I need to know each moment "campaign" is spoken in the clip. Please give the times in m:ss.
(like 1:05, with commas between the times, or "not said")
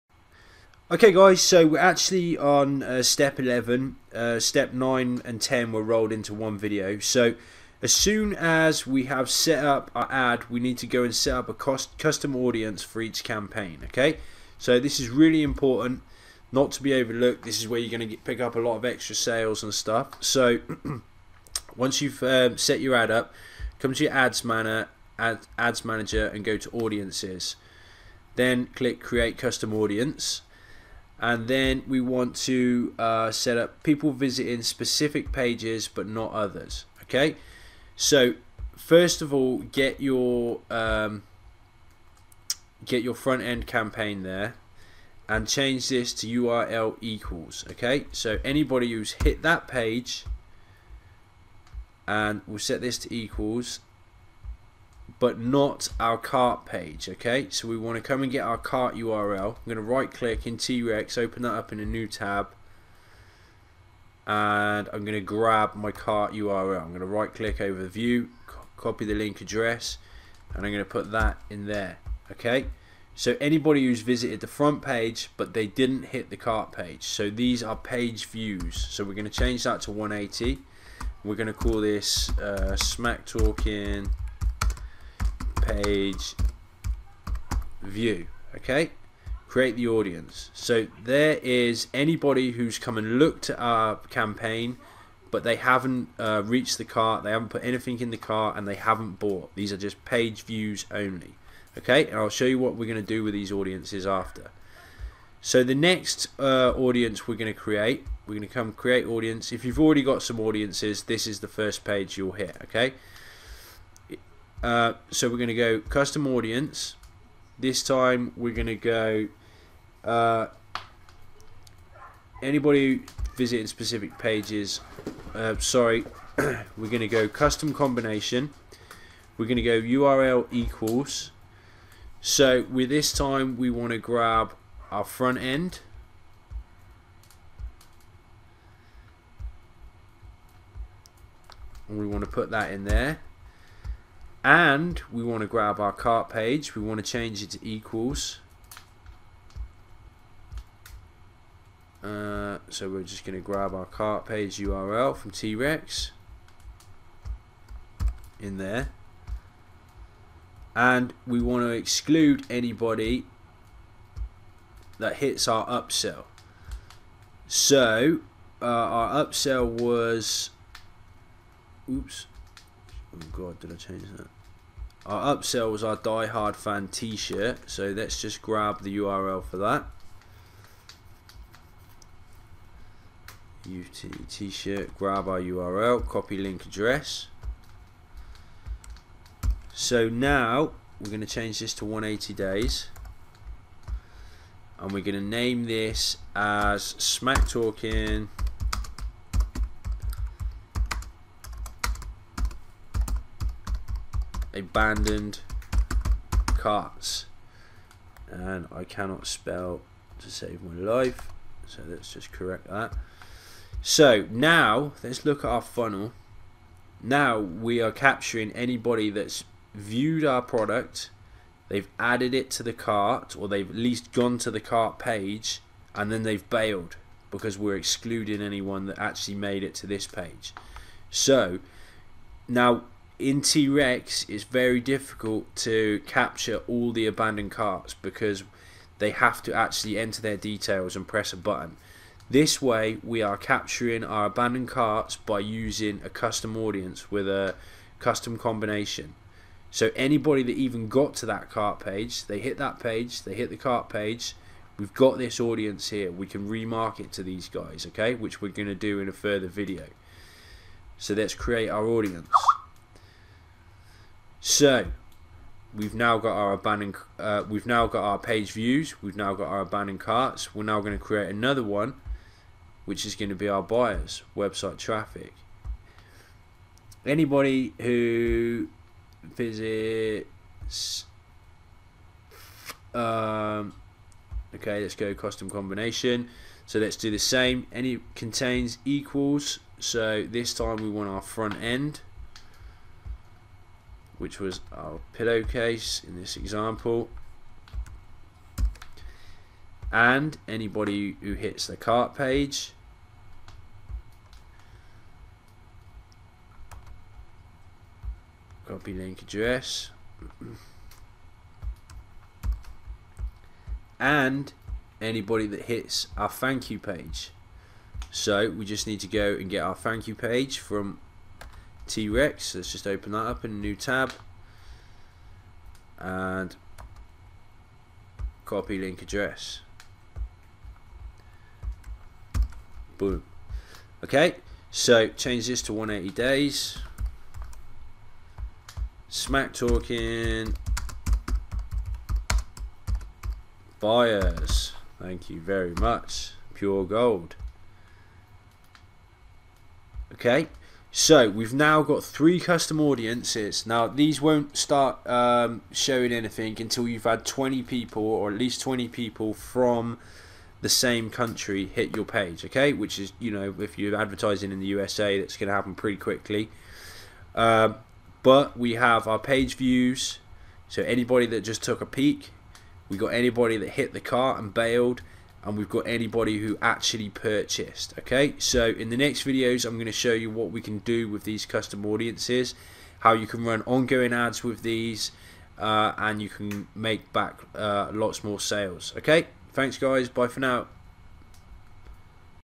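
0:13, 0:43, 1:34.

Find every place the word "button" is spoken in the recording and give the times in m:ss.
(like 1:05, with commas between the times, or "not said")
4:01.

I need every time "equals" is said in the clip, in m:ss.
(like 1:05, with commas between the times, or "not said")
0:46, 0:53, 2:10, 2:27, 4:48.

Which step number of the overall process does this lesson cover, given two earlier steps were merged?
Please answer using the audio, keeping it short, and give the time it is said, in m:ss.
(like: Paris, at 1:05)
11, at 0:03.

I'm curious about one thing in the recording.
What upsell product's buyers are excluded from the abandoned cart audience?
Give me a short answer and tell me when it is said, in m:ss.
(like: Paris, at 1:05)
Die Hard fan t-shirt, at 2:55.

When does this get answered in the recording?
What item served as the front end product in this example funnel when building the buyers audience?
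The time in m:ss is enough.
4:55.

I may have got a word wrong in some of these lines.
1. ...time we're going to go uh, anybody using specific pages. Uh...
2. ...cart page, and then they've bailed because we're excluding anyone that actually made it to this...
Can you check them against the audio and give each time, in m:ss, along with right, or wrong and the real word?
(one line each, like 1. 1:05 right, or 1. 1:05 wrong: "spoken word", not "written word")
1. 1:57 wrong: "visiting", not "using"
2. 3:44 right.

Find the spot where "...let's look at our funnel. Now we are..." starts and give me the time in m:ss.
3:35.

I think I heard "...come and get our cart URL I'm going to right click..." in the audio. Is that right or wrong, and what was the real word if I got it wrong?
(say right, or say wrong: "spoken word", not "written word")
right.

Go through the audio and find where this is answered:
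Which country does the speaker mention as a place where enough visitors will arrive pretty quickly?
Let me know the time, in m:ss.
6:04.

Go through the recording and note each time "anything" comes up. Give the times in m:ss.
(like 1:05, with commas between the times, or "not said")
1:37, 5:56.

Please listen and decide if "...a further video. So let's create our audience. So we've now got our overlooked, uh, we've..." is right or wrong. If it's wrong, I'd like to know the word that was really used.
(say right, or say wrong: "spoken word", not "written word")
wrong: "abandoned", not "overlooked".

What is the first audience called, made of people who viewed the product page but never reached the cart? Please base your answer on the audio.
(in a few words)
Smack talking page view.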